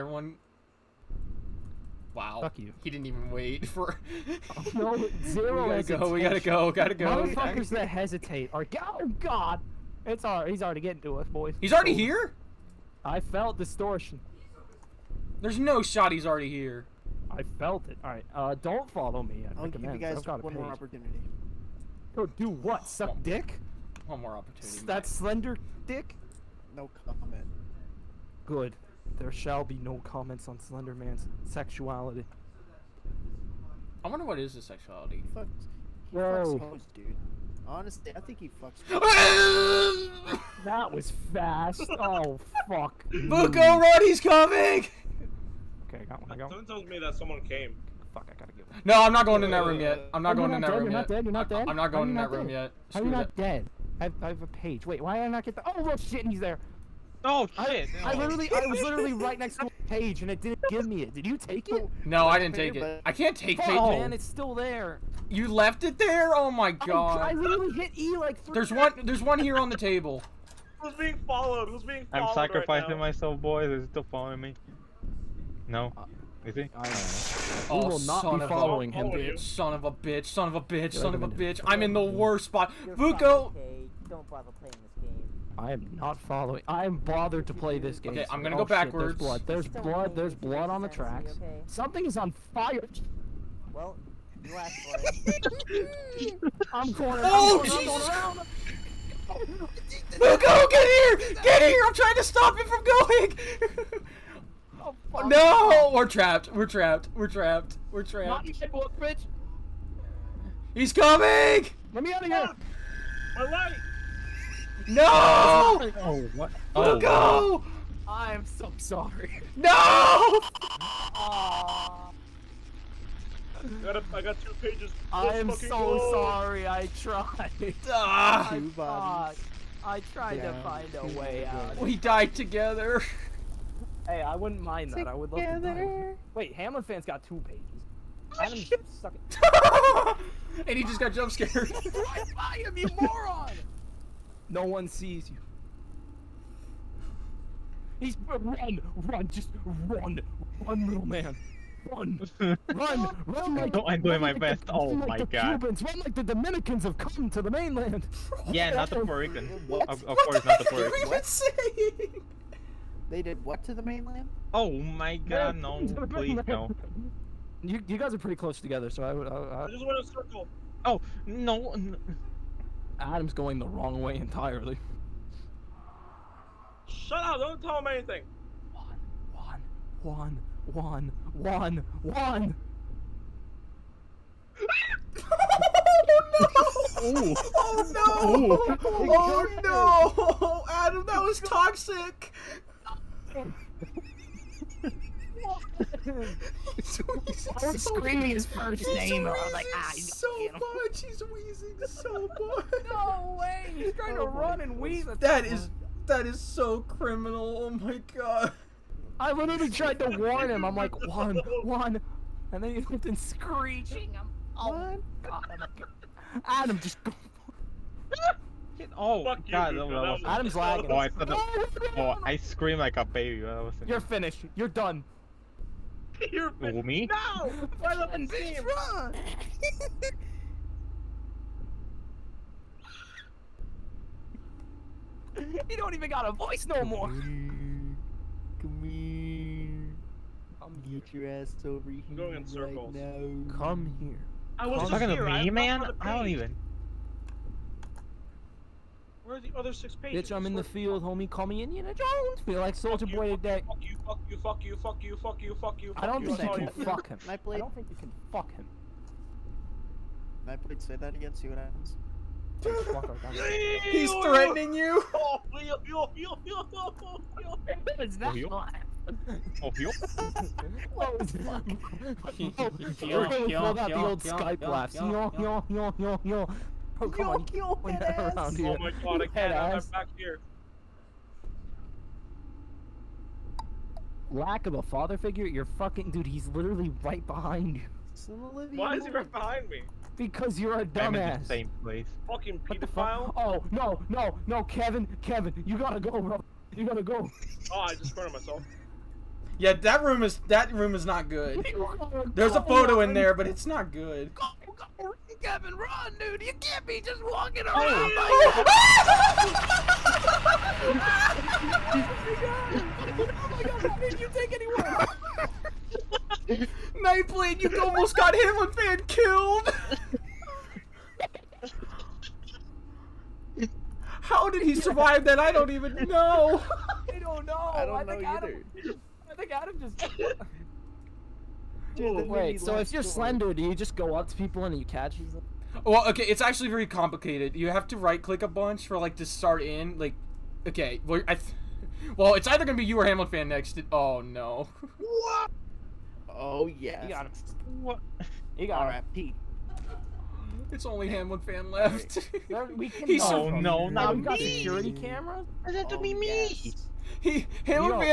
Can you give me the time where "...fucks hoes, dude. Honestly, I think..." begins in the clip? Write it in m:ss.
0:36.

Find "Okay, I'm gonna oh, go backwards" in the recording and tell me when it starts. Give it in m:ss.
1:28.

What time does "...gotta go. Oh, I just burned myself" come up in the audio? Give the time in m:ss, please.
4:56.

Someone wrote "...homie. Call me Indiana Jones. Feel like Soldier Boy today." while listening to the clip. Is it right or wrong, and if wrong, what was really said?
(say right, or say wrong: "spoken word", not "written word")
right.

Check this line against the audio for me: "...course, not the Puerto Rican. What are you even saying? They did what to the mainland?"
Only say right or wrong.
right.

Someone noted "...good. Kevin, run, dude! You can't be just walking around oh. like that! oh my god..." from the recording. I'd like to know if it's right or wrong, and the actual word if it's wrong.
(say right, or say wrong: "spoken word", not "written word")
right.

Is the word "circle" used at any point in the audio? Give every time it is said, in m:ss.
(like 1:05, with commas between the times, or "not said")
2:50, 4:02.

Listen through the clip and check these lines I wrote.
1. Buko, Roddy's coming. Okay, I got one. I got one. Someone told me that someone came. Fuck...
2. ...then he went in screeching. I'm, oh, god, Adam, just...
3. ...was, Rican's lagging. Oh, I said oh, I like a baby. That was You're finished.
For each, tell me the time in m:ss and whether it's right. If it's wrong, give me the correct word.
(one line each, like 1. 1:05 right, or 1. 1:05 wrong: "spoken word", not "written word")
1. 0:43 right
2. 3:32 right
3. 3:39 wrong: "Adam", not "Rican".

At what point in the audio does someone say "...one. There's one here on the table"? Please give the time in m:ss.
1:08.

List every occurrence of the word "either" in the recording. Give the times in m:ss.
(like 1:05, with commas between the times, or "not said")
5:28, 5:42.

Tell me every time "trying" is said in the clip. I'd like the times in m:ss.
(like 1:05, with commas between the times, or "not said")
1:41, 3:23.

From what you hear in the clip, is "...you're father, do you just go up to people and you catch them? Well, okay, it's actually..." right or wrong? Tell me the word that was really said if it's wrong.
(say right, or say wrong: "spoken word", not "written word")
wrong: "slender", not "father".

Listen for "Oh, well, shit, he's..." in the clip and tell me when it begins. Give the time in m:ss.
0:55.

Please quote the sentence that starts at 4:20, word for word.
Can I please say that again?